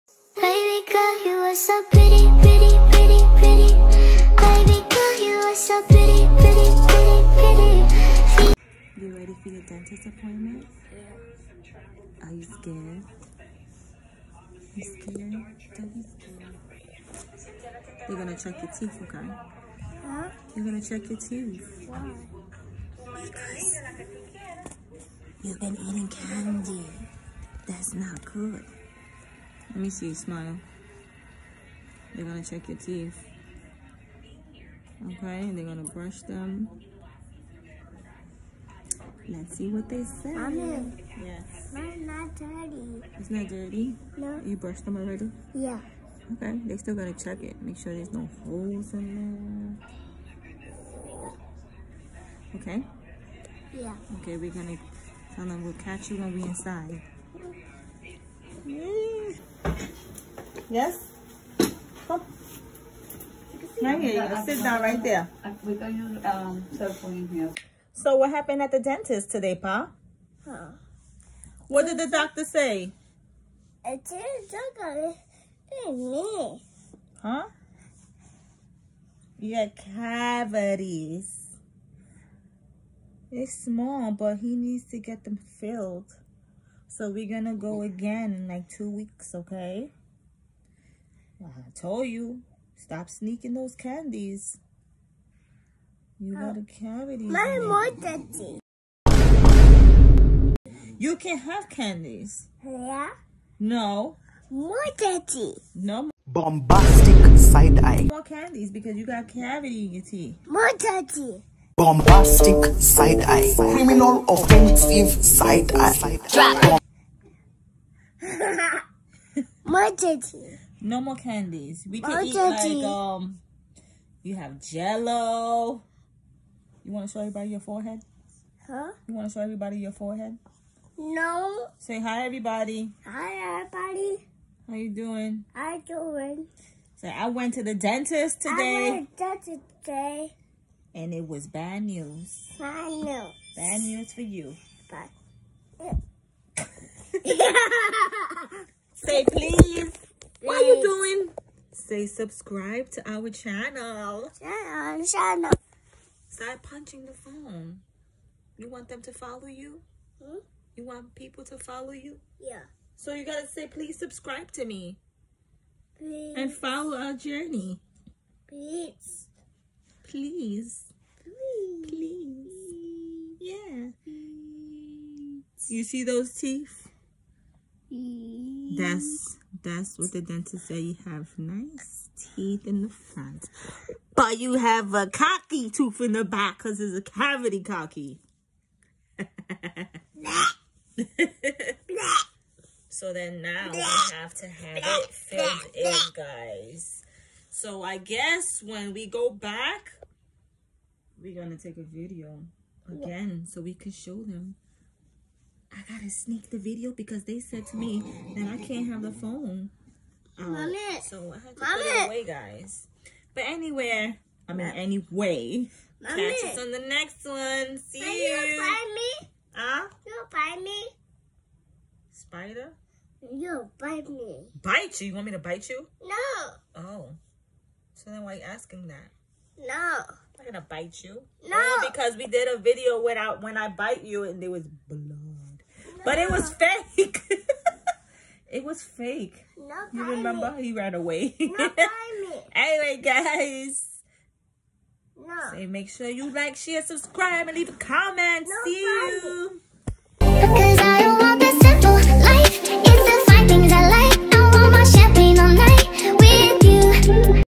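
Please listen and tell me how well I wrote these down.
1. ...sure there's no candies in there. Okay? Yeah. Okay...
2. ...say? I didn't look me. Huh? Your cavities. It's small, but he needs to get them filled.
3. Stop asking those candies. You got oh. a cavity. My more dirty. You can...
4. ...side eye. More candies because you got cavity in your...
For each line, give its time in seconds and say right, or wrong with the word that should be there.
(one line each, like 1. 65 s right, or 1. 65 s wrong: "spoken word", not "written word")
1. 47 s wrong: "holes", not "candies"
2. 72 s right
3. 92 s wrong: "sneaking", not "asking"
4. 107 s right.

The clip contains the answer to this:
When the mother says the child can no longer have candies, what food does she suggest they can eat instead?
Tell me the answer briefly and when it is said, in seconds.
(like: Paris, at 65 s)
Jello, at 124 s.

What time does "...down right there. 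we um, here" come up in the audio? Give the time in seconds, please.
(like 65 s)
64 s.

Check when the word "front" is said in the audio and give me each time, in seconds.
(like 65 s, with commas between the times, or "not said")
182 s.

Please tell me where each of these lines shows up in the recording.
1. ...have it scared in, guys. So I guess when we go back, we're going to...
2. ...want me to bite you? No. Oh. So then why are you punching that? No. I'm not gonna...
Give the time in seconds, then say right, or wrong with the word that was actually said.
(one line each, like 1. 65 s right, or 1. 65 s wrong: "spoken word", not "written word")
1. 194 s wrong: "filled", not "scared"
2. 225 s wrong: "asking", not "punching".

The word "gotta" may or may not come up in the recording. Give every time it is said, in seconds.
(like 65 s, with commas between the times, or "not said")
46 s, 163 s, 205 s.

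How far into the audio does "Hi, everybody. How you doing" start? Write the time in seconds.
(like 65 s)
133 s.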